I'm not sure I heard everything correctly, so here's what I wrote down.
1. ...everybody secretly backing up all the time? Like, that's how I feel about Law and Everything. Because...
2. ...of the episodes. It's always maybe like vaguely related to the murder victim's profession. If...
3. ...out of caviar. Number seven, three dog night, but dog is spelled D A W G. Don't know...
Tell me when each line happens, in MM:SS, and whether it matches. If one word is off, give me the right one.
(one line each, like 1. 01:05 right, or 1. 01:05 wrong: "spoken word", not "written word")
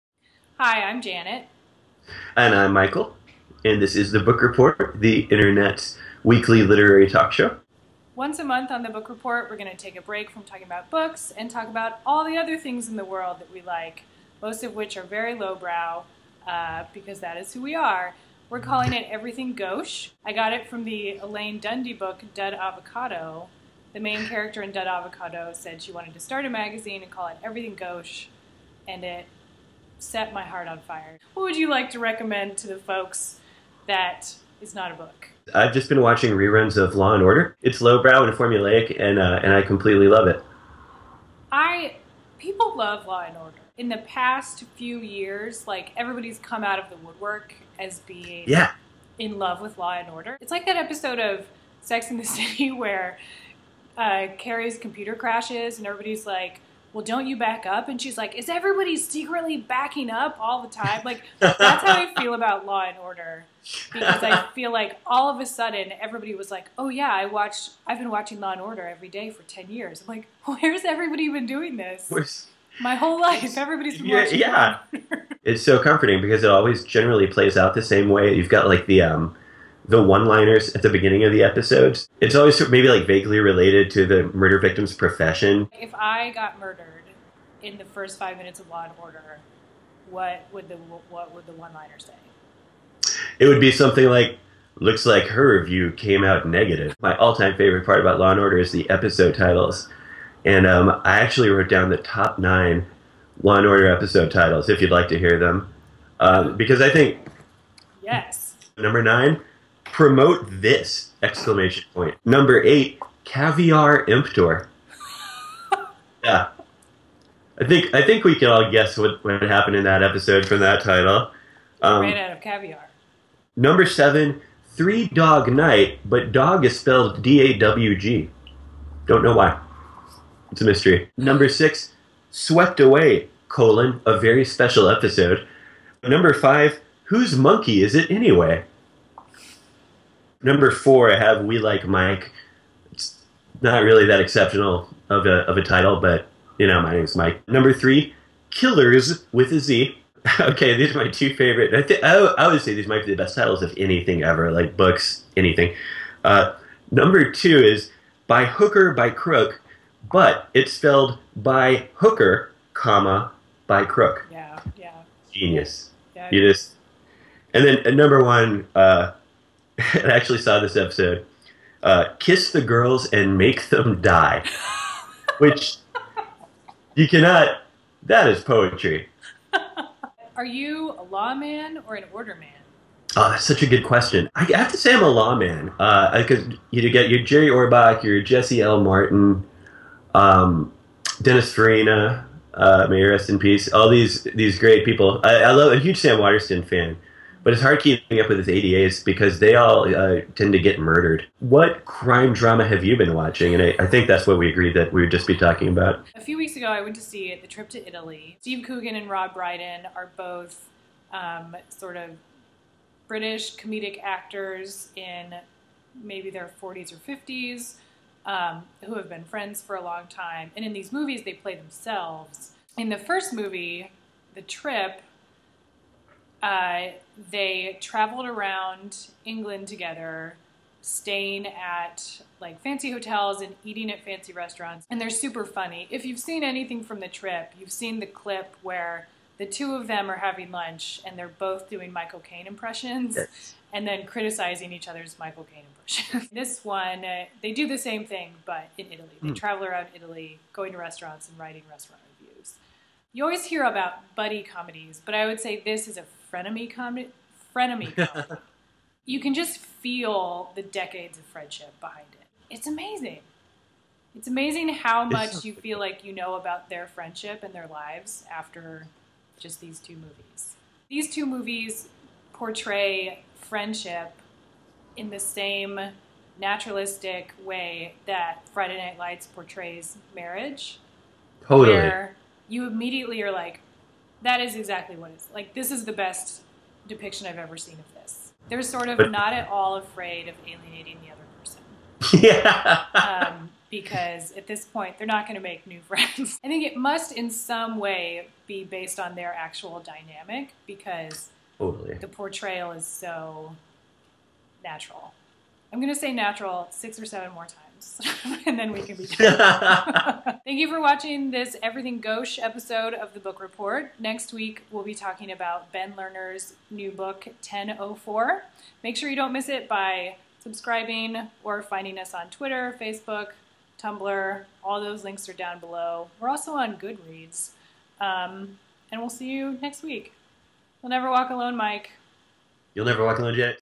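1. 00:58 wrong: "Order", not "Everything"
2. 01:21 right
3. 02:02 right.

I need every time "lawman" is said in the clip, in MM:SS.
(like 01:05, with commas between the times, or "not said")
03:01, 03:05.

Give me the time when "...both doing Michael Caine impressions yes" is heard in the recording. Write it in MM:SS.
04:01.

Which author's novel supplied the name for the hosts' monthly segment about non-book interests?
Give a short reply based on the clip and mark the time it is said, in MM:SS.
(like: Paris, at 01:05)
Elaine Dundy, at 00:21.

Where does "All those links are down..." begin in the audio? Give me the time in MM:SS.
05:24.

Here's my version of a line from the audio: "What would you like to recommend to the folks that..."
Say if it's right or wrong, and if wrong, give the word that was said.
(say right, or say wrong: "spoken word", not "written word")
right.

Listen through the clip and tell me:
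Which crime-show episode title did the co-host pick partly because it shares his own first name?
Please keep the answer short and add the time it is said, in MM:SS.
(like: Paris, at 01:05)
We Like Mike, at 02:21.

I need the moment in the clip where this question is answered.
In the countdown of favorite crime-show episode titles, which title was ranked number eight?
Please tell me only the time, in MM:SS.
01:53.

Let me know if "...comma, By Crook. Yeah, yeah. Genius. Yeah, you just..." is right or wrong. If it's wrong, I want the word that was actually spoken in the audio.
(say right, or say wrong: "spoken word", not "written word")
right.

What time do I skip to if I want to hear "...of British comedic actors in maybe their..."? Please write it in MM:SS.
03:31.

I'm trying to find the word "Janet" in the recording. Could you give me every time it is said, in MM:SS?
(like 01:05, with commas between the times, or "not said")
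00:01, 05:33.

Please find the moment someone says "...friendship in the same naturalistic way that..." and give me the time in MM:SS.
04:33.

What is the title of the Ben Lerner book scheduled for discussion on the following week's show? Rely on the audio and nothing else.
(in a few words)
1004.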